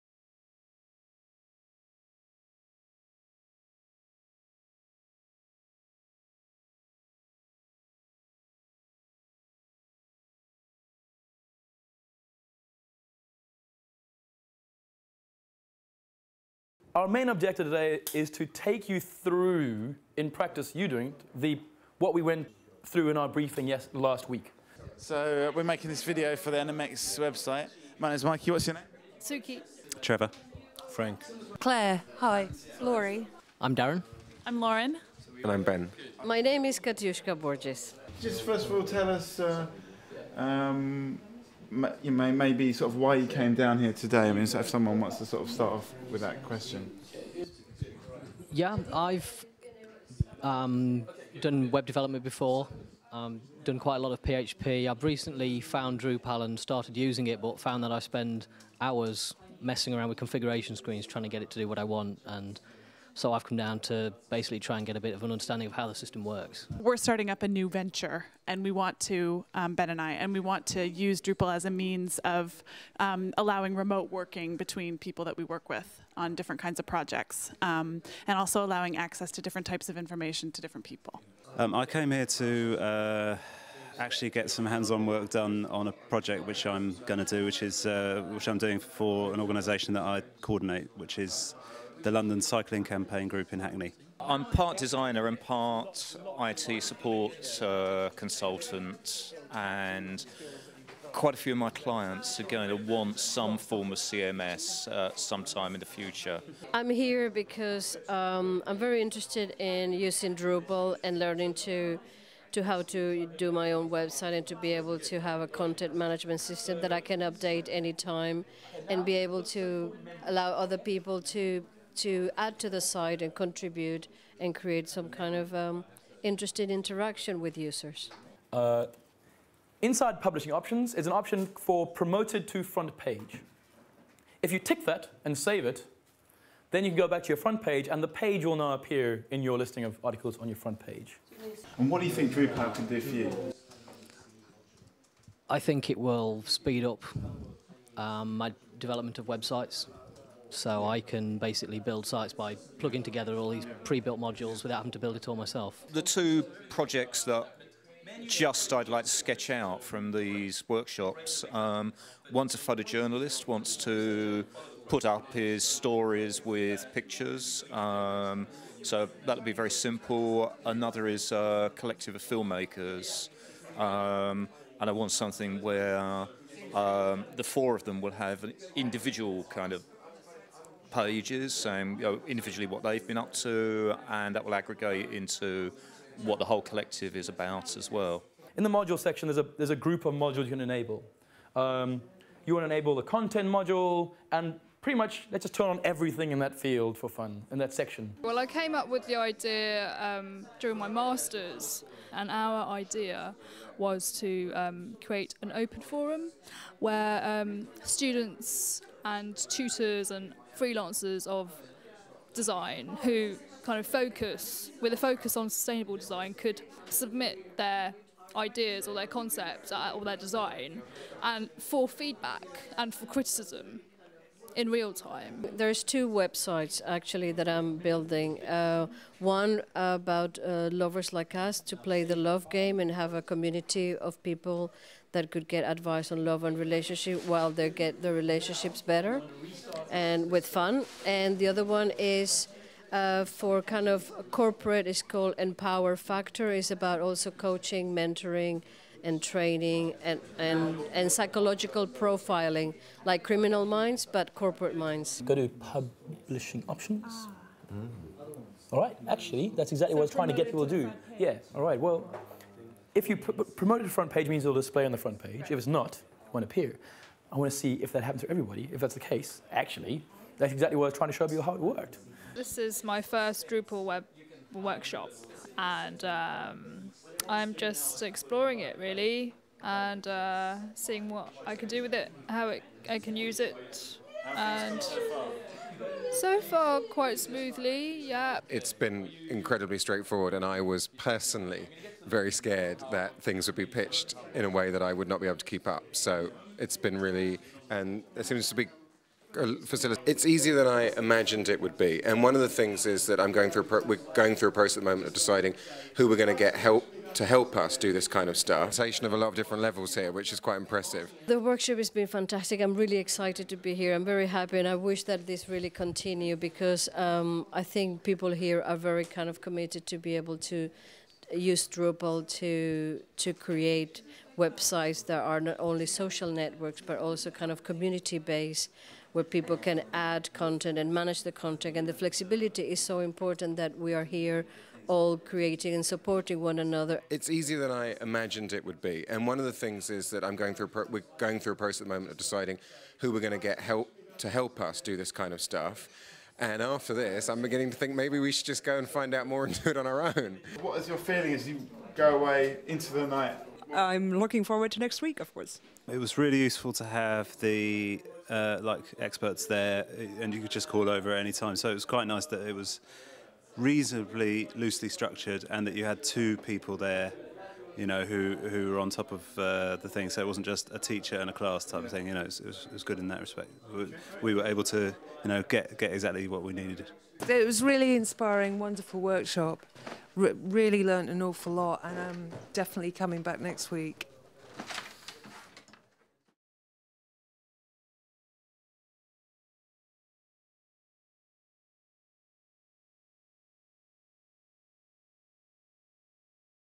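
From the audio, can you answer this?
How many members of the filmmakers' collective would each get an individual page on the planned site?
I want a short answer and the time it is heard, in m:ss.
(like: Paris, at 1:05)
4, at 2:57.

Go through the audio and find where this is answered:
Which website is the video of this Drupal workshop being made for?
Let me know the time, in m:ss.
0:26.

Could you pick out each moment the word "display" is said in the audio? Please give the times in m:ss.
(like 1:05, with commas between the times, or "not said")
4:24.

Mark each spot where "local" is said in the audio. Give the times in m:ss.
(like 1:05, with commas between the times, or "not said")
not said.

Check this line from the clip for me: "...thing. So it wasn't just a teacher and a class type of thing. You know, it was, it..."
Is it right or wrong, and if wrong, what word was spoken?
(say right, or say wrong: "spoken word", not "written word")
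right.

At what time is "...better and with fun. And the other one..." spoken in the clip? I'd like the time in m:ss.
3:58.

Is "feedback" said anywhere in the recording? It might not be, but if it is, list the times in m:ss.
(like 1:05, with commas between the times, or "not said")
3:41.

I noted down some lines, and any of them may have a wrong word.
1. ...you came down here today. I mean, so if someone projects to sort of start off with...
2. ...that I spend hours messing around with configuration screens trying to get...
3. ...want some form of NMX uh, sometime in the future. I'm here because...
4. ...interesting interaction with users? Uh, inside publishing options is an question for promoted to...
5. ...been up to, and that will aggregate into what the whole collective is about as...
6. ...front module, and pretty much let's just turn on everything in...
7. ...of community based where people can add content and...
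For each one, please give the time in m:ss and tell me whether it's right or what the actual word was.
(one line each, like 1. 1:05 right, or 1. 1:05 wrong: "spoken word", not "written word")
1. 0:43 wrong: "wants", not "projects"
2. 0:57 right
3. 1:42 wrong: "CMS", not "NMX"
4. 2:06 wrong: "option", not "question"
5. 3:03 right
6. 3:13 wrong: "content", not "front"
7. 5:27 right.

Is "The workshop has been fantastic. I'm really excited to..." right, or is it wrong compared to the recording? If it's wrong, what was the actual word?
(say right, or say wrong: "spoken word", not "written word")
right.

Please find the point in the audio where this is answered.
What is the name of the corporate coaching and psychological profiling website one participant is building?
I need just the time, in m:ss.
4:05.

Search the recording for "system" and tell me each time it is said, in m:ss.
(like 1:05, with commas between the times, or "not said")
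1:05, 1:56.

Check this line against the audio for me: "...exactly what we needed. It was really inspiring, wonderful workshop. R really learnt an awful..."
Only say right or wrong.
right.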